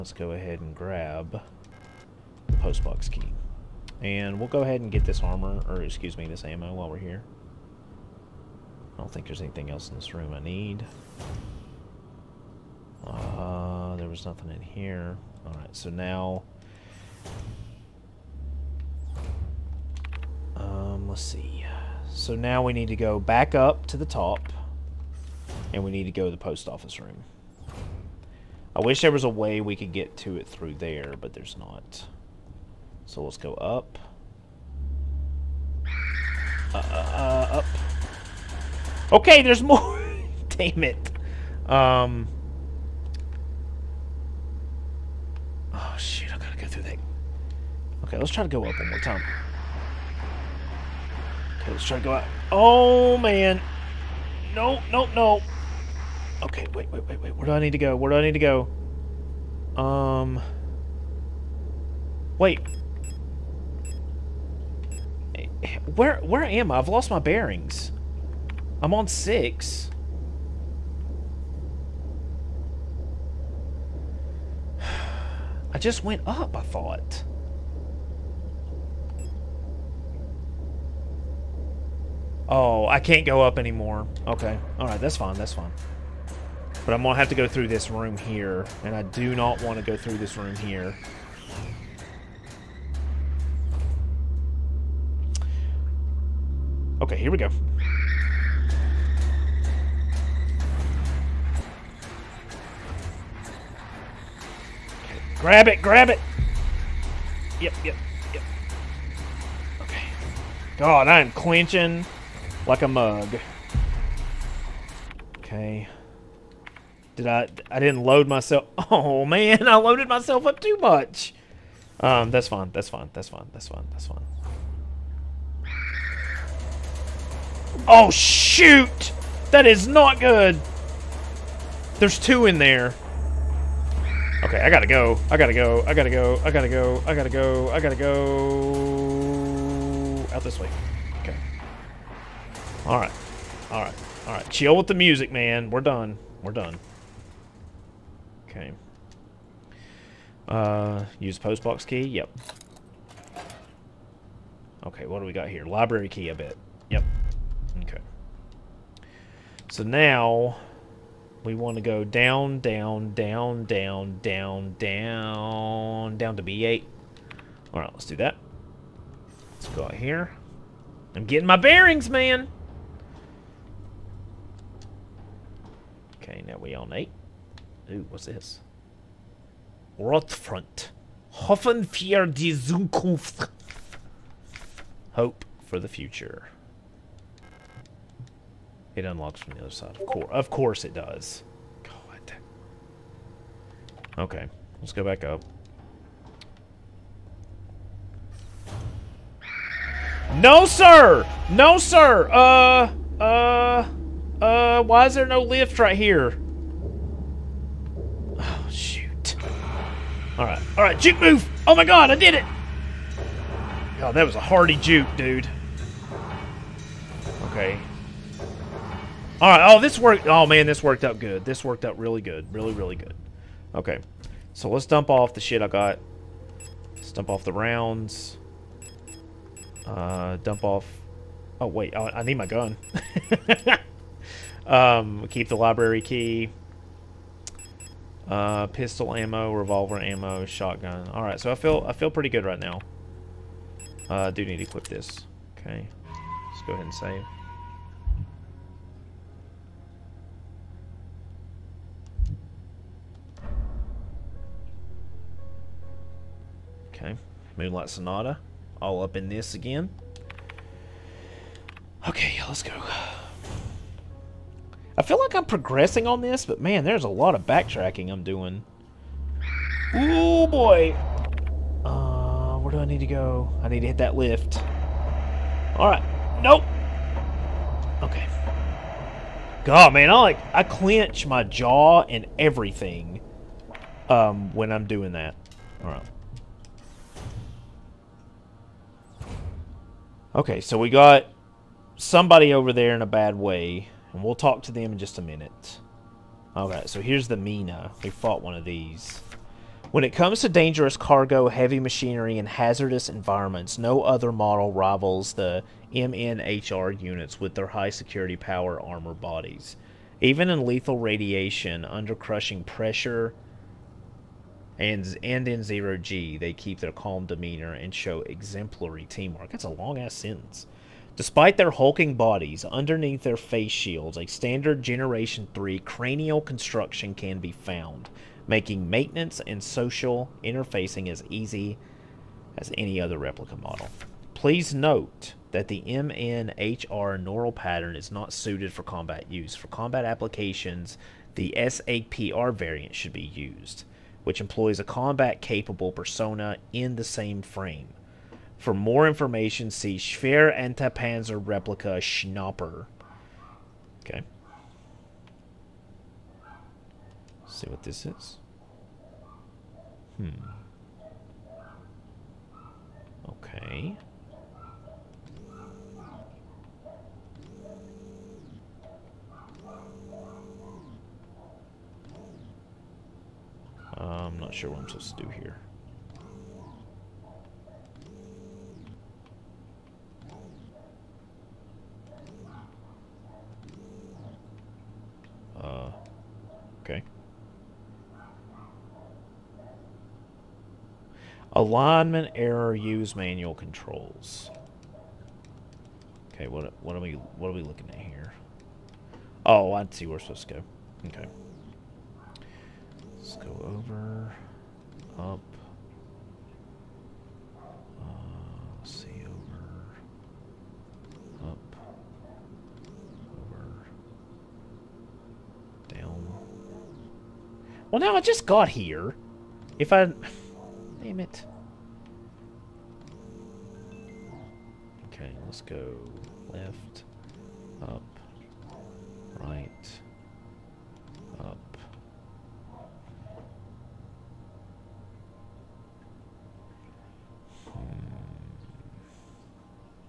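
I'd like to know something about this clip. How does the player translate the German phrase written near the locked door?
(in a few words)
Hope for the future.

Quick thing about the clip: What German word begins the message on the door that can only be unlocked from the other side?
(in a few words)
Rotfront.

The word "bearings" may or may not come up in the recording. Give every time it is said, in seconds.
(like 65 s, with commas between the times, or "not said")
67 s, 171 s.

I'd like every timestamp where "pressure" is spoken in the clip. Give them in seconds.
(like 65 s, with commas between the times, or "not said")
312 s.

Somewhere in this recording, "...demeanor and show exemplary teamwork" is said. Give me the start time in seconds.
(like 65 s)
317 s.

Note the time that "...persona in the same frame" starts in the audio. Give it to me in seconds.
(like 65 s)
345 s.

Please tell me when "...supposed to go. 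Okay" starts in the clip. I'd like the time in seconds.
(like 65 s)
400 s.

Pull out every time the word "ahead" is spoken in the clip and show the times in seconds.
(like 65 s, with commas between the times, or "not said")
0 s, 4 s, 246 s.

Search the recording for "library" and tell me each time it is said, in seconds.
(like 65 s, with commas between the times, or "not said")
155 s, 235 s.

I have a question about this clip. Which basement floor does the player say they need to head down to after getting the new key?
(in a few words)
B8.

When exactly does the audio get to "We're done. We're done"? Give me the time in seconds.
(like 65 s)
145 s.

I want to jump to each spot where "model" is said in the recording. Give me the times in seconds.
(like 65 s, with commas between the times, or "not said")
304 s, 333 s.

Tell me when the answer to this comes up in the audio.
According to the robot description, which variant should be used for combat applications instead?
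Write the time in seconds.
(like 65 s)
341 s.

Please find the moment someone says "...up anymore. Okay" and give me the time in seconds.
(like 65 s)
83 s.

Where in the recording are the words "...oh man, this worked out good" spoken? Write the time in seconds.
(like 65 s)
220 s.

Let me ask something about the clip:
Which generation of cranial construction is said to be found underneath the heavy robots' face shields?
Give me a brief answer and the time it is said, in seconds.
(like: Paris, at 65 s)
Generation 3, at 324 s.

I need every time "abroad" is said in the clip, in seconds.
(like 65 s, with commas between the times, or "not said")
not said.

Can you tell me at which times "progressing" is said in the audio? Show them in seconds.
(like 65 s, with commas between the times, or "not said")
265 s.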